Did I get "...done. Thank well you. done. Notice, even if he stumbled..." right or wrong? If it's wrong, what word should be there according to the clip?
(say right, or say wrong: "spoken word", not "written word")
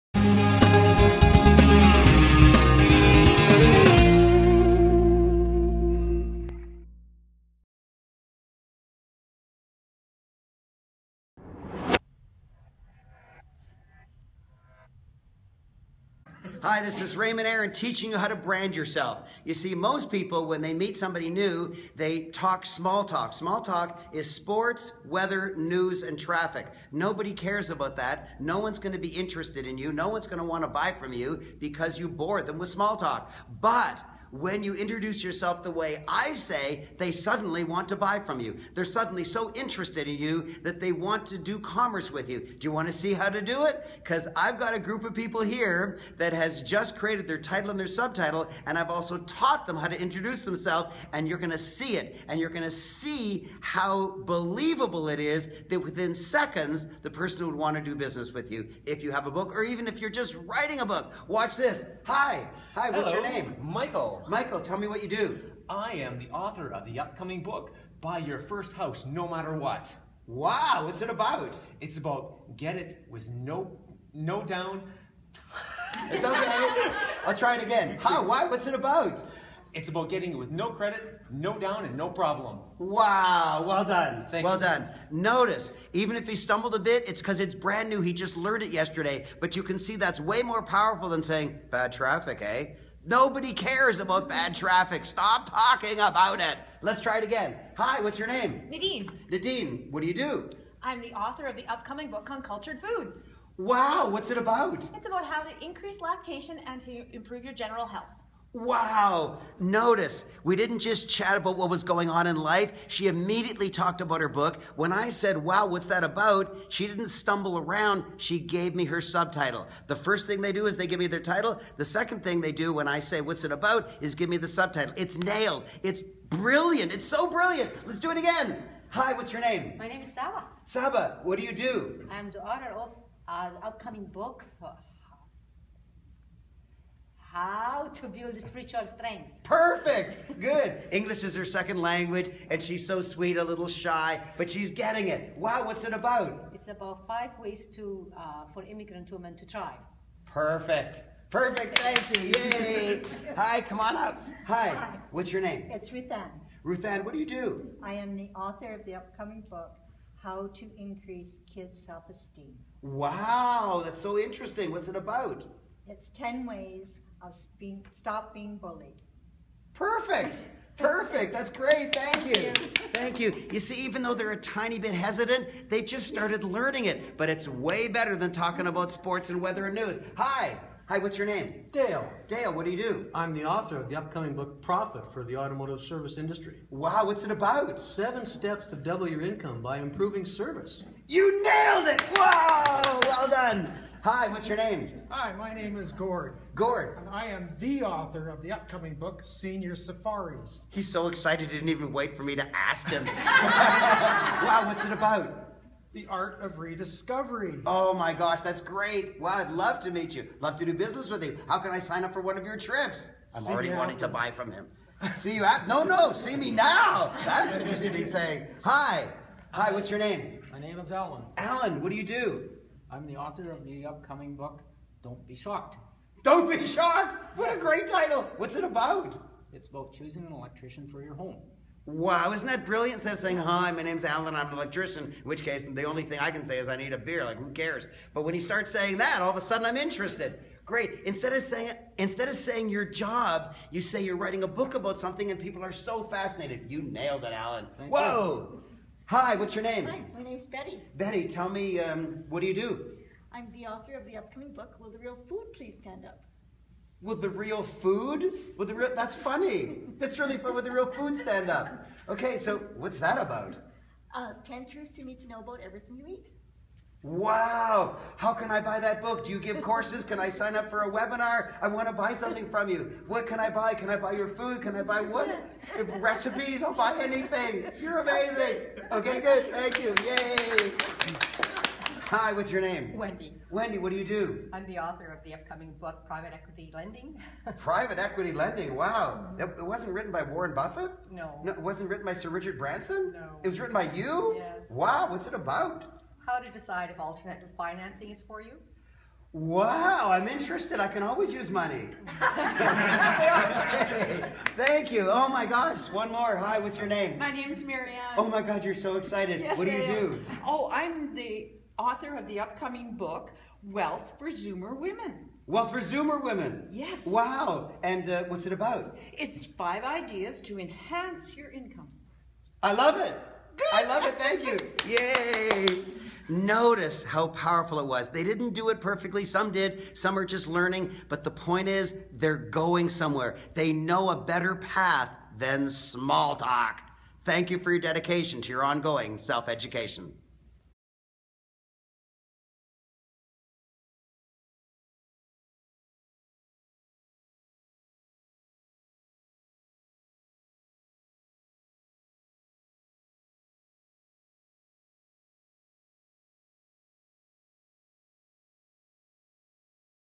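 right.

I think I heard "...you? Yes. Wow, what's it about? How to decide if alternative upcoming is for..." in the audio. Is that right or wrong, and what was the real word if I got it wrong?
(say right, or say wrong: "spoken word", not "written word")
wrong: "financing", not "upcoming".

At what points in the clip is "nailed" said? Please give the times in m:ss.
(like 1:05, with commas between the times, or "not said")
2:05, 3:11, 4:06.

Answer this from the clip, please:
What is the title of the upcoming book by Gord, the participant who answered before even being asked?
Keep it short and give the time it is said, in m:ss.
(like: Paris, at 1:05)
Senior Safaris, at 3:19.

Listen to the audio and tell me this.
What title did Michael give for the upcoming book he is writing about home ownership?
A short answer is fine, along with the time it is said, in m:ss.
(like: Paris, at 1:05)
Buy Your First House No Matter What, at 1:08.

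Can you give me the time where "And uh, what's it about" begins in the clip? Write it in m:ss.
5:17.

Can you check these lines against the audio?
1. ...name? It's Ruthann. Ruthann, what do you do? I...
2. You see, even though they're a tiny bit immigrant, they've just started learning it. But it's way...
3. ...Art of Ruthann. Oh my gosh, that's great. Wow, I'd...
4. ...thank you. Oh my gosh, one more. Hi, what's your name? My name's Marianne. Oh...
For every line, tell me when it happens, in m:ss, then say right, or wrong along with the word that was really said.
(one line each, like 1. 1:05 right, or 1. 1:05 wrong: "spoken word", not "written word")
1. 2:35 right
2. 2:53 wrong: "hesitant", not "immigrant"
3. 3:26 wrong: "Rediscovery", not "Ruthann"
4. 5:04 right.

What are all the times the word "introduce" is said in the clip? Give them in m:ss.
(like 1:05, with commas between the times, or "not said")
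0:34, 0:49.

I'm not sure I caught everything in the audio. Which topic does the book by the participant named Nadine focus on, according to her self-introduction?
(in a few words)
cultured foods.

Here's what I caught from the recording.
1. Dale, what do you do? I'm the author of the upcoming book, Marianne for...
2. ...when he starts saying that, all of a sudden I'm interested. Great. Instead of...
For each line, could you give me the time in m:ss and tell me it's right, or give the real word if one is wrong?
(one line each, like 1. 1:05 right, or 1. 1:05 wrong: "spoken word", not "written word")
1. 3:02 wrong: "Profit", not "Marianne"
2. 3:58 right.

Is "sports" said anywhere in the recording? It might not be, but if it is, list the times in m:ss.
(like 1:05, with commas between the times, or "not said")
0:24, 2:58.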